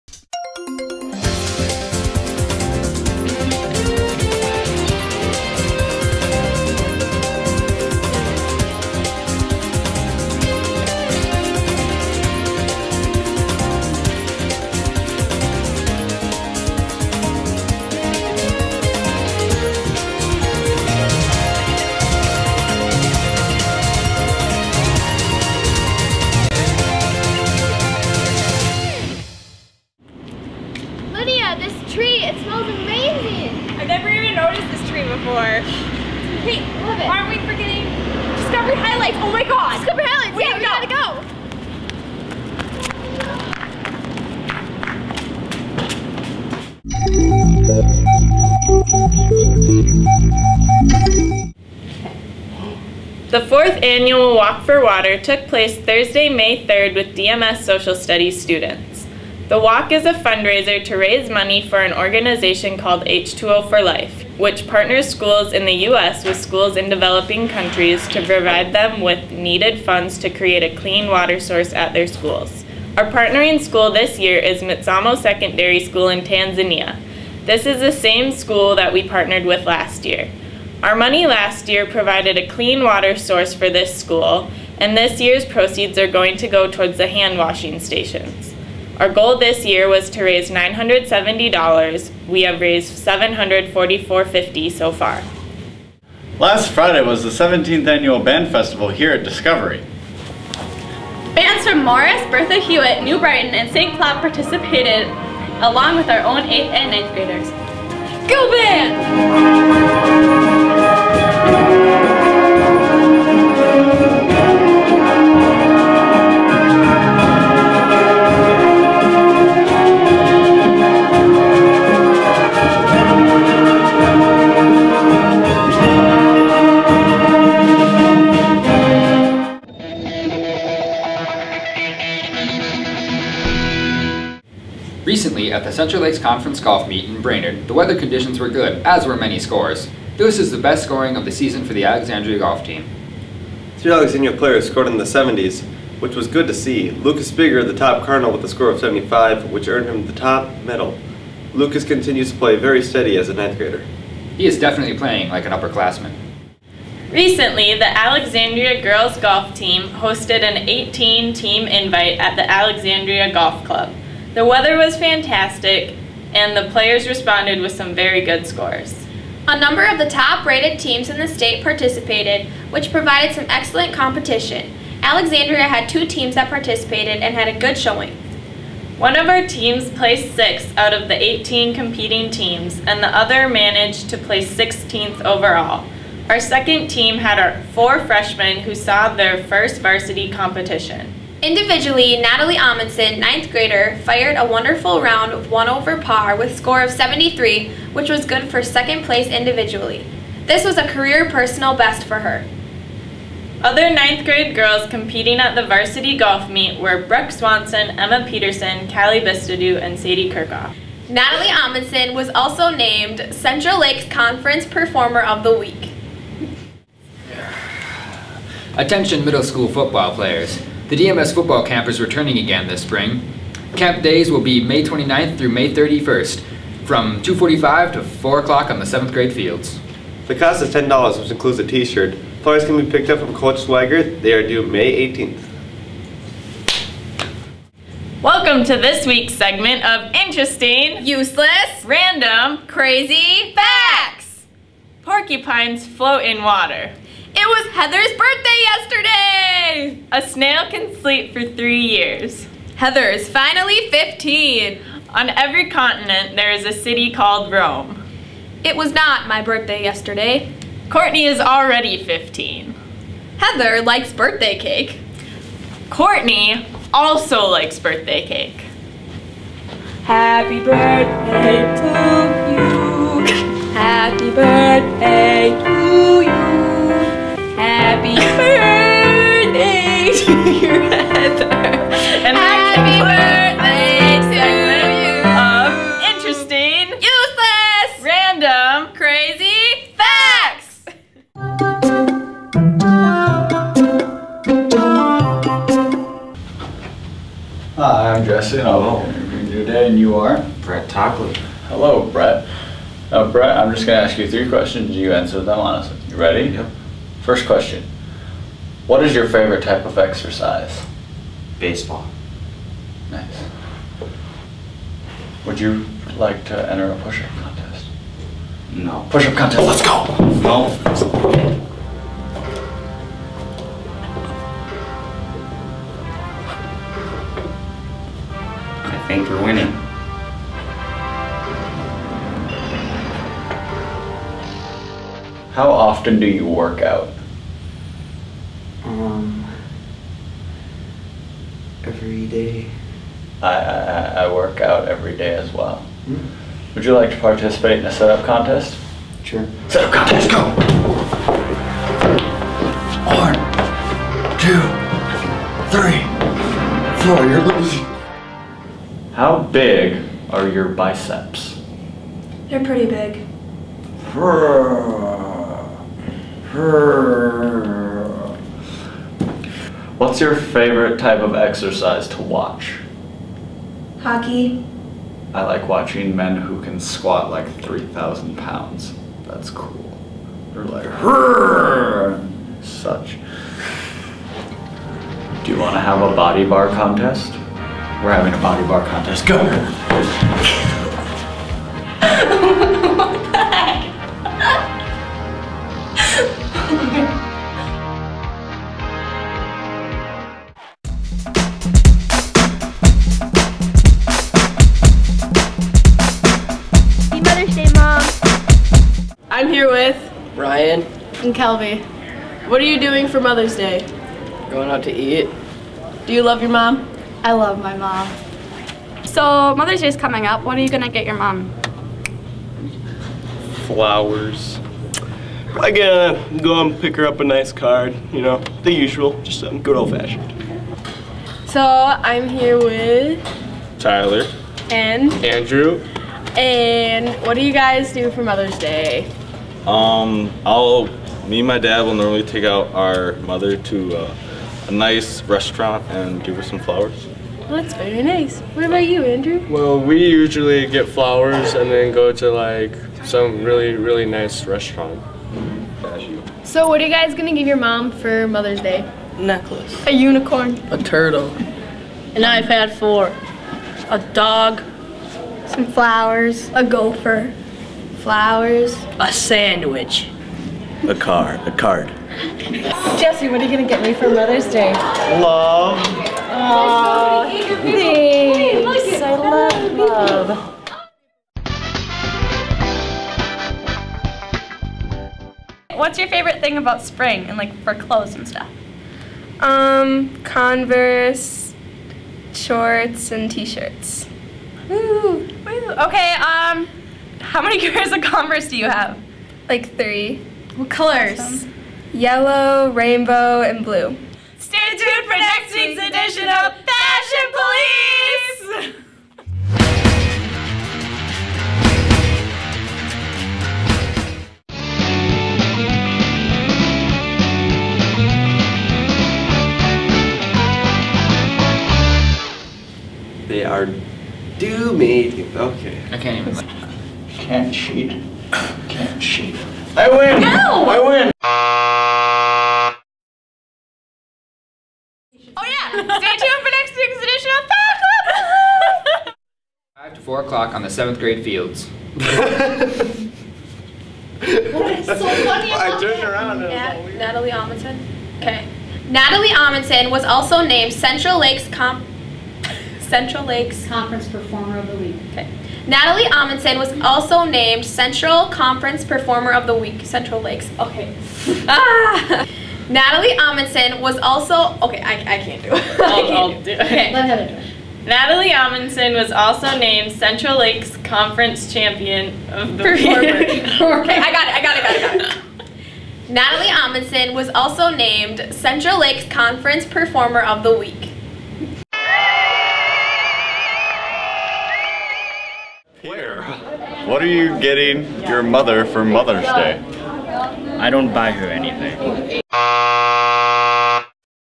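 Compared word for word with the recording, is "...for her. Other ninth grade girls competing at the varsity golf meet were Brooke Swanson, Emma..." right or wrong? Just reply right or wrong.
right.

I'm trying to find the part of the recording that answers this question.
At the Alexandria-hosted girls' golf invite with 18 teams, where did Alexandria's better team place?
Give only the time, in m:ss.
3:00.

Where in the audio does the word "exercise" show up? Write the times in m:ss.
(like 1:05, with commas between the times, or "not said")
5:09, 6:11.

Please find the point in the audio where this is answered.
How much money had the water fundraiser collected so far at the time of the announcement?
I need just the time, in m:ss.
1:33.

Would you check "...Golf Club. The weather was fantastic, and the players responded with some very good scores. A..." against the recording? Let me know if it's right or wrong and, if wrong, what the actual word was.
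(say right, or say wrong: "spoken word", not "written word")
right.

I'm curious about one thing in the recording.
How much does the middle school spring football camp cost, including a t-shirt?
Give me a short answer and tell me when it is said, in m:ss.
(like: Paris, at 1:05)
$10, at 3:50.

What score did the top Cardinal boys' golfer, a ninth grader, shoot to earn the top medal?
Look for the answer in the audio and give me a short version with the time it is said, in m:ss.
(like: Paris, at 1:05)
75, at 2:28.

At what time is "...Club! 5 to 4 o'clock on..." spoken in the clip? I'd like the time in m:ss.
8:59.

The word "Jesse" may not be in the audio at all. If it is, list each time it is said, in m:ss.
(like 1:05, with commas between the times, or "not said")
4:58, 7:52.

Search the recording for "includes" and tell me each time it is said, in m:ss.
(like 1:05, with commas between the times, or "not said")
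3:51.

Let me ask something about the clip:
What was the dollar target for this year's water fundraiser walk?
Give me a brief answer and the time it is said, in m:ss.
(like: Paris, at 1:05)
$970, at 1:30.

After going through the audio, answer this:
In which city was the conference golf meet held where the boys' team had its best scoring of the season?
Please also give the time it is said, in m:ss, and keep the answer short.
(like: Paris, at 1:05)
Brainerd, at 2:17.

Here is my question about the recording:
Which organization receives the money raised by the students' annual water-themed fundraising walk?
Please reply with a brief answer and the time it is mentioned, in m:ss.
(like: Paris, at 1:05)
H2O for Life, at 1:03.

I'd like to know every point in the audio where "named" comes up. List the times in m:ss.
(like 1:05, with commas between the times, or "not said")
3:32, 9:10, 9:17, 9:29, 9:37.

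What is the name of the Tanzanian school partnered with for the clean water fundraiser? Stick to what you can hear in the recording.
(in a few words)
Mitsamo Secondary School.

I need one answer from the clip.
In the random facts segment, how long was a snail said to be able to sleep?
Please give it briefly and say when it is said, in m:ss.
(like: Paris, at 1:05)
three years, at 4:11.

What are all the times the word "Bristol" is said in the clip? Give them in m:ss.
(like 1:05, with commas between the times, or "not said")
not said.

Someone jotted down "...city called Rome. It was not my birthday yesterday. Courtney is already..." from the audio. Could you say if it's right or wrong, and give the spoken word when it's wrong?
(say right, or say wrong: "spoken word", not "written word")
right.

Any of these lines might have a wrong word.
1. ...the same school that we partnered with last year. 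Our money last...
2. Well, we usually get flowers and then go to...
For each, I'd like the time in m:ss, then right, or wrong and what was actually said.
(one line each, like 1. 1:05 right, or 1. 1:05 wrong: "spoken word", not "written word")
1. 1:17 right
2. 7:29 right.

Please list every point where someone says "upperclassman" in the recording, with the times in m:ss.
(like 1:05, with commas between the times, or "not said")
2:35.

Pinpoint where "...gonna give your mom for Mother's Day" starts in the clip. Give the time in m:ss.
7:37.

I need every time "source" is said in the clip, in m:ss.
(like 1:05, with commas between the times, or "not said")
1:11, 1:23.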